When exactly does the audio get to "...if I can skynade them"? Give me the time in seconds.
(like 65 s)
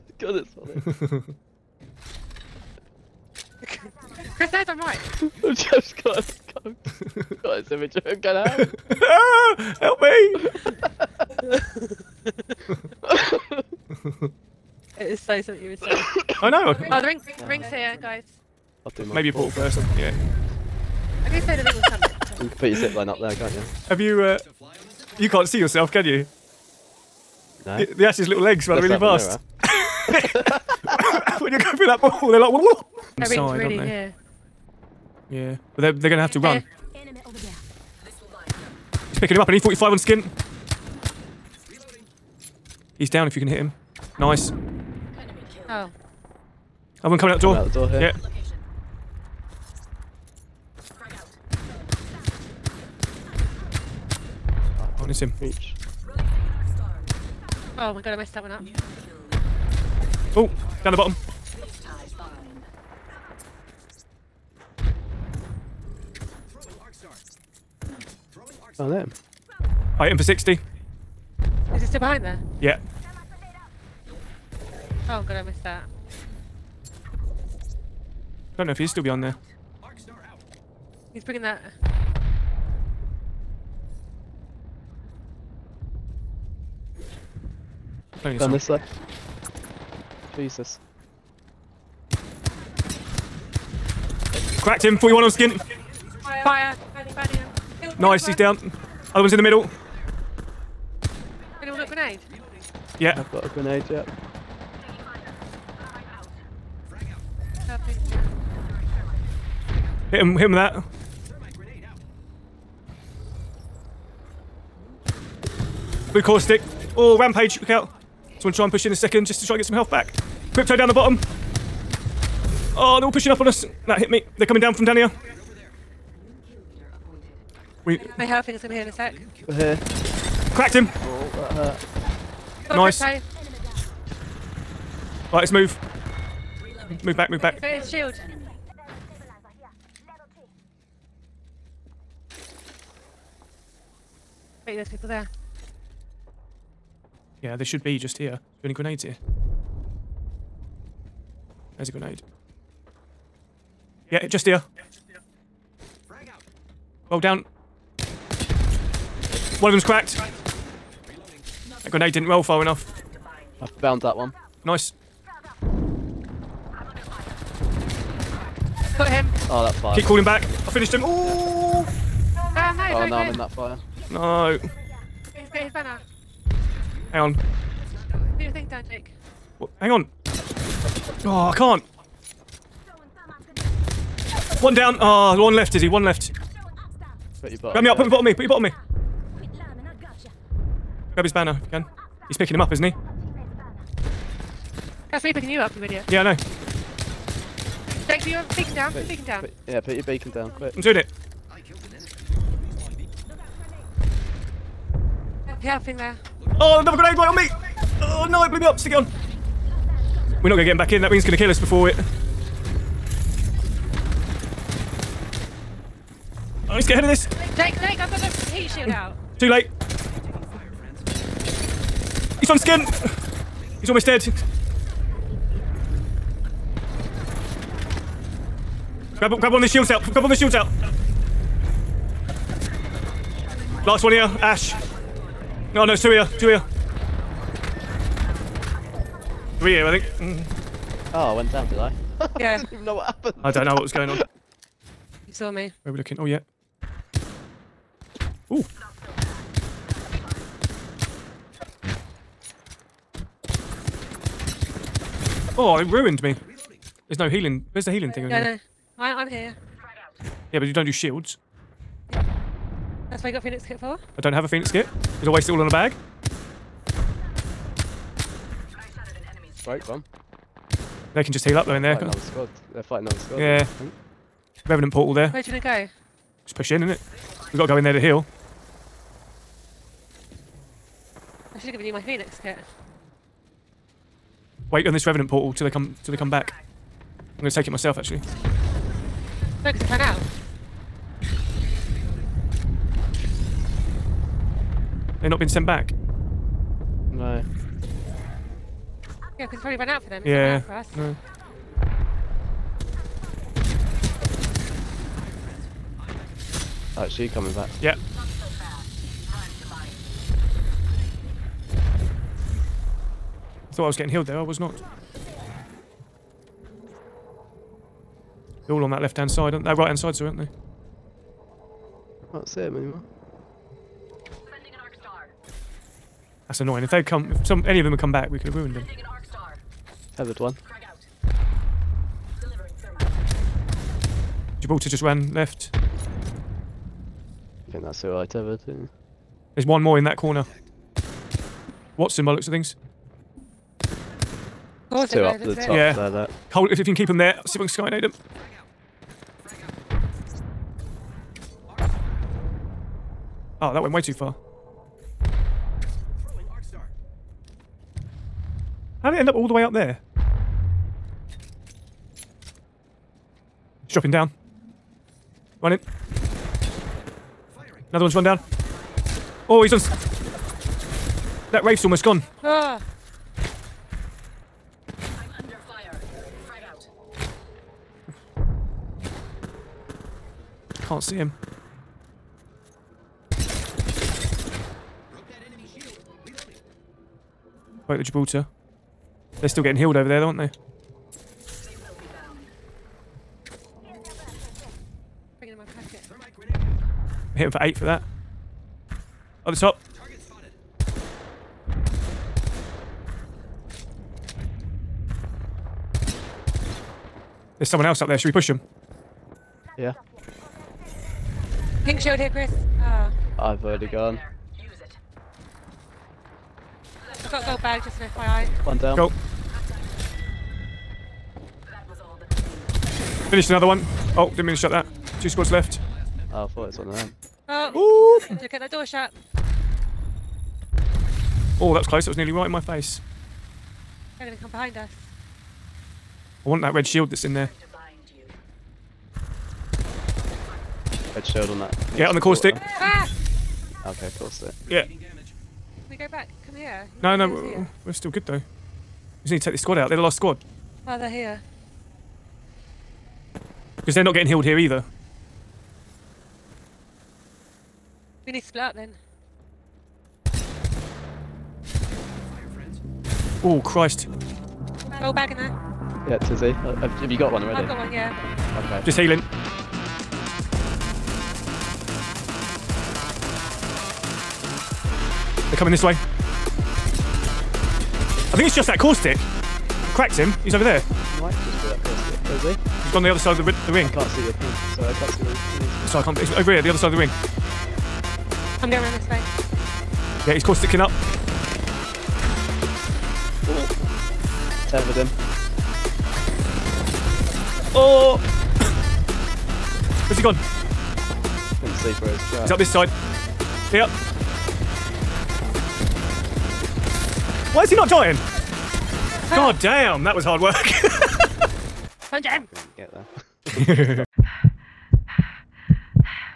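347 s.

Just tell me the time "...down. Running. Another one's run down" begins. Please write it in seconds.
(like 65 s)
364 s.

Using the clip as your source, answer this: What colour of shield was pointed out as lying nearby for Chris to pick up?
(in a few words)
Pink.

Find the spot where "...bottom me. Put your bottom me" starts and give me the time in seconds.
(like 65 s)
188 s.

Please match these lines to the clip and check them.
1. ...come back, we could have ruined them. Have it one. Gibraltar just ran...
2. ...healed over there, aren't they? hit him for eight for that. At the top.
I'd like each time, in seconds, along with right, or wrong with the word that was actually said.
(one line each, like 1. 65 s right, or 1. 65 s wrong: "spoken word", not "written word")
1. 327 s right
2. 389 s right.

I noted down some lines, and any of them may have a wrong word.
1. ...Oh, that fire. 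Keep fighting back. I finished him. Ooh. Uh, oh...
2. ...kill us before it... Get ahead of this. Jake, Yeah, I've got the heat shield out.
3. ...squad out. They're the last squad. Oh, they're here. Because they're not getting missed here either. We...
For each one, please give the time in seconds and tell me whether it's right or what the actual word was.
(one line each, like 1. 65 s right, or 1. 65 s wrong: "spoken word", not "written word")
1. 169 s wrong: "calling", not "fighting"
2. 211 s wrong: "Jake", not "Yeah"
3. 449 s wrong: "healed", not "missed".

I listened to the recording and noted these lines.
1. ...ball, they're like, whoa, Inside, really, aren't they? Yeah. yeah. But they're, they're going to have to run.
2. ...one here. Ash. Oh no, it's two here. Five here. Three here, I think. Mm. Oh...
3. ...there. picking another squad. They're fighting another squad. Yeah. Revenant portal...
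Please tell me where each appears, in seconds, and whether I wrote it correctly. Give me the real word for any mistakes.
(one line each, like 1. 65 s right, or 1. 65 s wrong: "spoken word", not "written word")
1. 32 s right
2. 234 s wrong: "Two", not "Five"
3. 271 s wrong: "fighting", not "picking".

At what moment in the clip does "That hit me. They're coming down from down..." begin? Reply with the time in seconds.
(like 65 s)
123 s.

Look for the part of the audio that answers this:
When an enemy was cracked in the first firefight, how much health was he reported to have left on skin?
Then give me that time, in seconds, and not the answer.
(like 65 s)
94 s.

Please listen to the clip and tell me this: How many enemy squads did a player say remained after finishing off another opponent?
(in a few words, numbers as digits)
2.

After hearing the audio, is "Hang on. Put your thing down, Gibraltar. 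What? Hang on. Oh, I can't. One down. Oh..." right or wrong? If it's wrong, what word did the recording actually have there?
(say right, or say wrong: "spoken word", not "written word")
wrong: "Jake", not "Gibraltar".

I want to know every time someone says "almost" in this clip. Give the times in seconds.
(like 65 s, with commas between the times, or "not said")
223 s, 371 s.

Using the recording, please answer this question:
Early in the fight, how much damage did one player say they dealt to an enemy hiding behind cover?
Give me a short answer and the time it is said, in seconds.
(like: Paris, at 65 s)
60, at 69 s.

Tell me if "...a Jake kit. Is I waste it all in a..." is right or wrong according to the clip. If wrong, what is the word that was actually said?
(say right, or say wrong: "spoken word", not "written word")
wrong: "Phoenix", not "Jake".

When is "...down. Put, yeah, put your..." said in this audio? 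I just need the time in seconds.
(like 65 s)
199 s.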